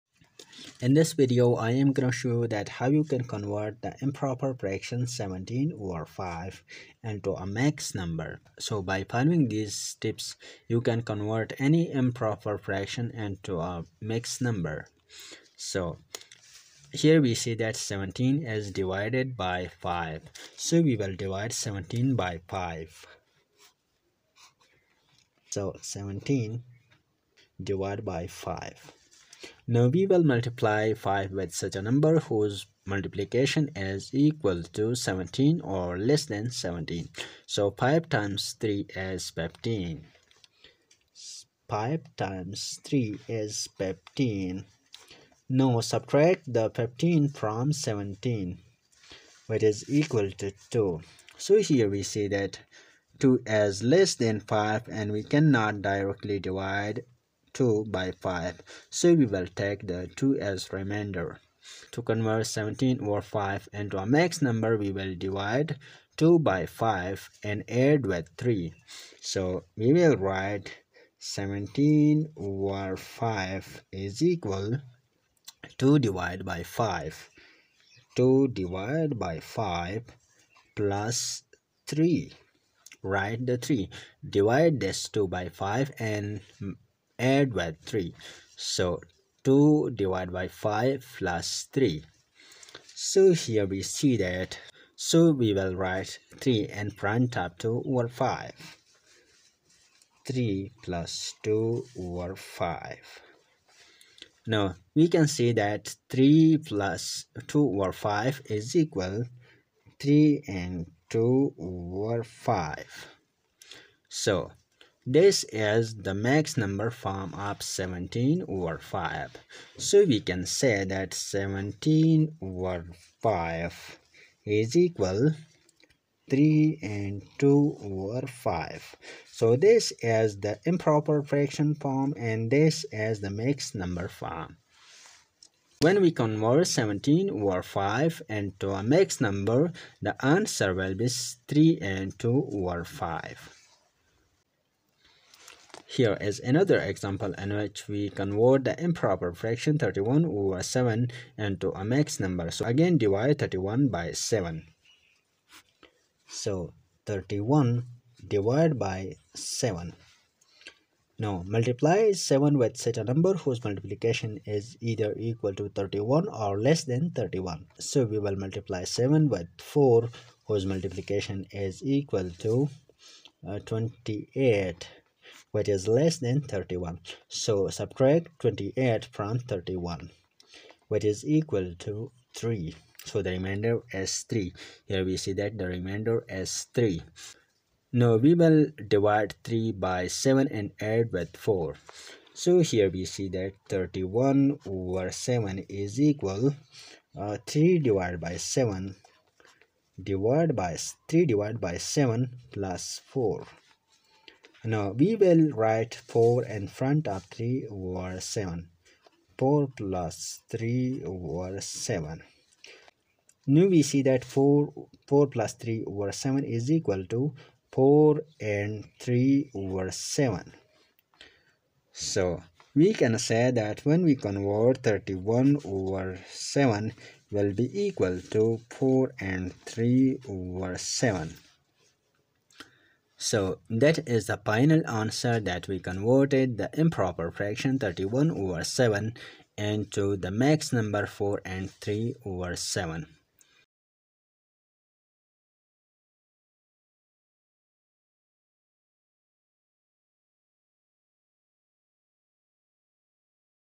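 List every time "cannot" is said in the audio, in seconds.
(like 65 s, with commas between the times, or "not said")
55 s.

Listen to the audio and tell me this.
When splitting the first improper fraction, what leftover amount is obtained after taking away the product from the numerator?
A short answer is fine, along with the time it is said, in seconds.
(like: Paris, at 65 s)
2, at 49 s.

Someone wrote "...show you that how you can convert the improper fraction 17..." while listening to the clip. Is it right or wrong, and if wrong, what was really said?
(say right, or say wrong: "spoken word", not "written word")
right.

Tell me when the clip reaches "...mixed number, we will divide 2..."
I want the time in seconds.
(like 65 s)
64 s.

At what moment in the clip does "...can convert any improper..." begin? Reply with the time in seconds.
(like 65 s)
10 s.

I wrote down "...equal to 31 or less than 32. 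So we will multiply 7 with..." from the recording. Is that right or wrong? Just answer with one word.
wrong.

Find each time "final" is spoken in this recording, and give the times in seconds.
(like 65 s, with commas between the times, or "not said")
234 s.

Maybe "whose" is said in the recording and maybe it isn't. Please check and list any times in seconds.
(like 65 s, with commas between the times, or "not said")
32 s, 163 s, 170 s.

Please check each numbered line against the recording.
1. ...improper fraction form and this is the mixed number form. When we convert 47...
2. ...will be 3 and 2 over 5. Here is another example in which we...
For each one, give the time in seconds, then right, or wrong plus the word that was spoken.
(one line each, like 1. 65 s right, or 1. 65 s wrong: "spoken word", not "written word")
1. 130 s wrong: "17", not "47"
2. 140 s right.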